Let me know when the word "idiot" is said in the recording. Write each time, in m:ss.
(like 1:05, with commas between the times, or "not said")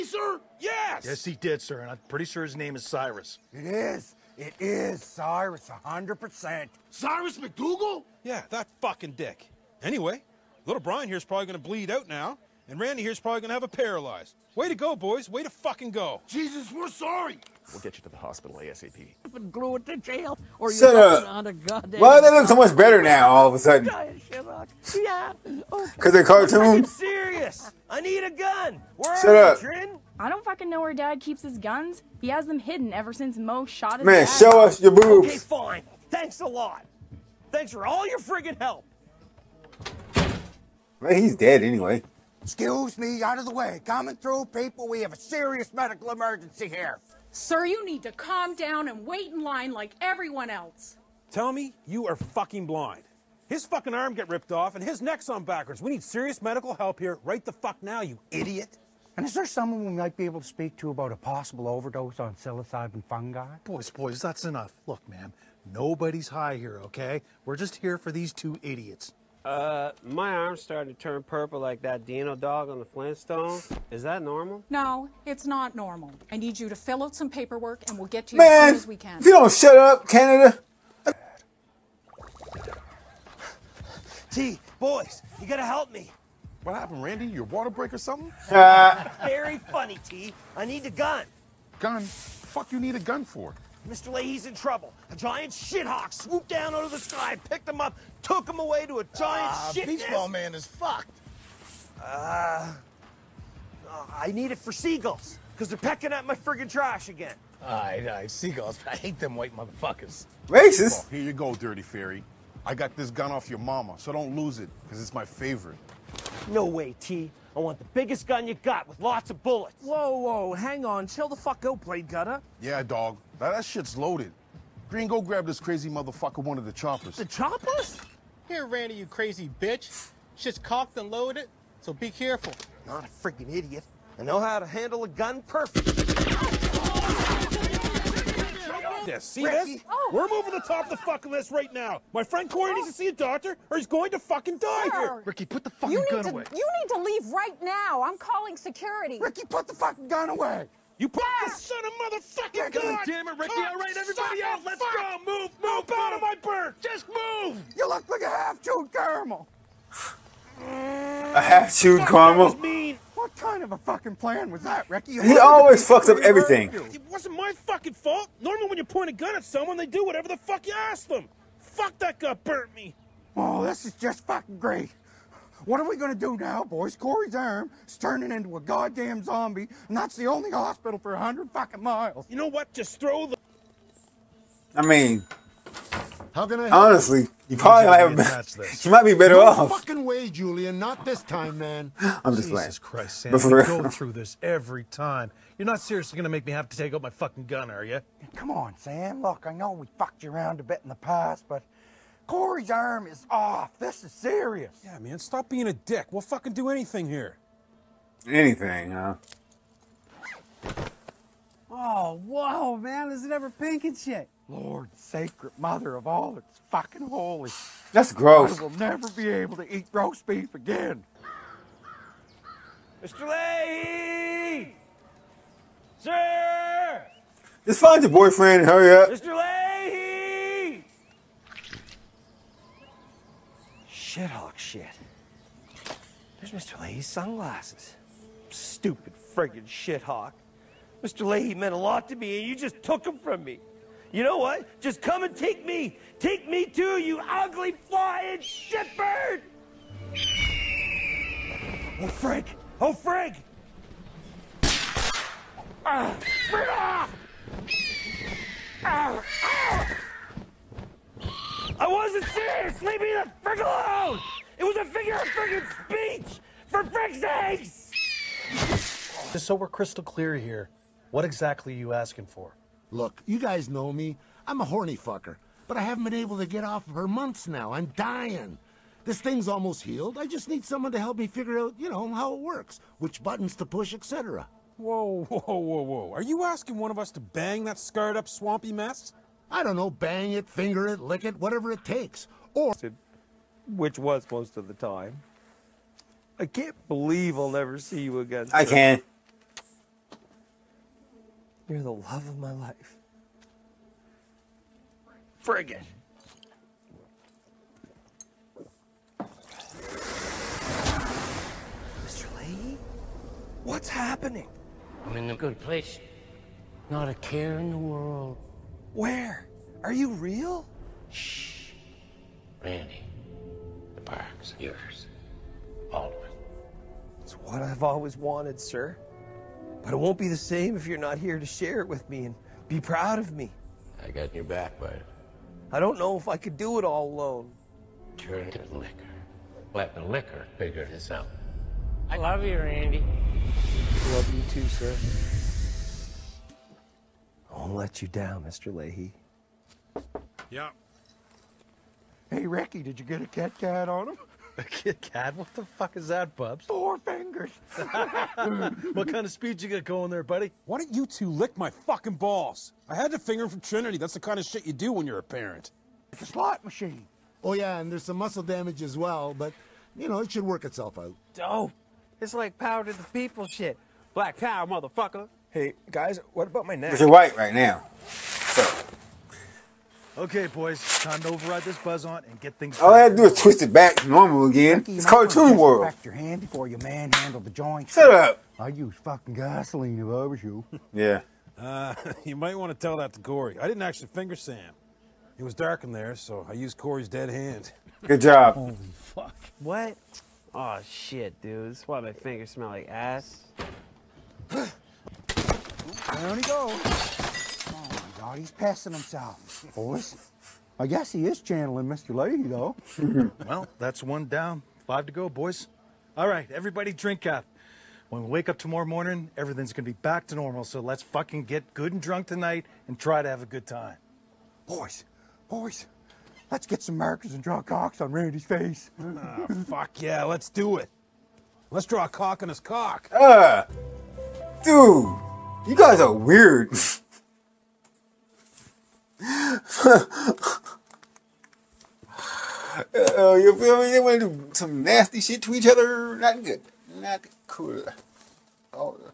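0:58, 1:08, 2:13.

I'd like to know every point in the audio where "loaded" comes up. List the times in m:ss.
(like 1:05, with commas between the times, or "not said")
2:03, 2:11.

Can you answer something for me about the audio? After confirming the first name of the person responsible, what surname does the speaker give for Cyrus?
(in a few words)
McDougal.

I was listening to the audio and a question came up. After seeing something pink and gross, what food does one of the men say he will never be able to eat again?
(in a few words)
Roast beef.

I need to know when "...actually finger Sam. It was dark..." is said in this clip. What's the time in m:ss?
6:33.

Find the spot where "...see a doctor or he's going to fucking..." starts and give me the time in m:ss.
2:22.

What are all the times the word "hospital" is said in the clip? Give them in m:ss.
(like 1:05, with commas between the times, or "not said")
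0:18, 3:00.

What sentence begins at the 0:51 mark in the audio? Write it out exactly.
Tell me you are fucking blind.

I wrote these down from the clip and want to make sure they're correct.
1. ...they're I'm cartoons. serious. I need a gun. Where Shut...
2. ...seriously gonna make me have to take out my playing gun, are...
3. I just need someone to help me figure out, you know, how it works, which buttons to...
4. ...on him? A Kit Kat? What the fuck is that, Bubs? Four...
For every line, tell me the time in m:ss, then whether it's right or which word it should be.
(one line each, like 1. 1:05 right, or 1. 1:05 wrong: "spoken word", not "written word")
1. 0:26 right
2. 3:15 wrong: "fucking", not "playing"
3. 4:40 right
4. 5:53 right.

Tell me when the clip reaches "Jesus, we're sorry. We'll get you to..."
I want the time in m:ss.
0:16.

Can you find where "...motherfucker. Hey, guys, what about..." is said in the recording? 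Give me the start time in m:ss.
6:14.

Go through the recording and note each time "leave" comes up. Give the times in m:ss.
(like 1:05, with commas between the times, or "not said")
2:27, 4:22.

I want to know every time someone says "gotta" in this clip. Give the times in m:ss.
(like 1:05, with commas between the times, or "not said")
1:25.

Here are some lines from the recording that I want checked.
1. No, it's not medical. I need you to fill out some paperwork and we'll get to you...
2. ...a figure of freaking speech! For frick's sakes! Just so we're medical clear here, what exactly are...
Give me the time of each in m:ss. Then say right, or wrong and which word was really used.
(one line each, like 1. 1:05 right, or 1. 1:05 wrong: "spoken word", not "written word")
1. 1:14 wrong: "normal", not "medical"
2. 4:24 wrong: "crystal", not "medical".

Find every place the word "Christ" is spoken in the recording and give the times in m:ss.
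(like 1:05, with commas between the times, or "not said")
3:13.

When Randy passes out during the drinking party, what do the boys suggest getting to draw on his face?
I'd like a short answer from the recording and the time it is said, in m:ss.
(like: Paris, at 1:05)
Markers, at 7:06.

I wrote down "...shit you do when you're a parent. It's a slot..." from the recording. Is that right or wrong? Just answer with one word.
right.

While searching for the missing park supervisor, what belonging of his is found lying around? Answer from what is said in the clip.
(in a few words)
Sunglasses.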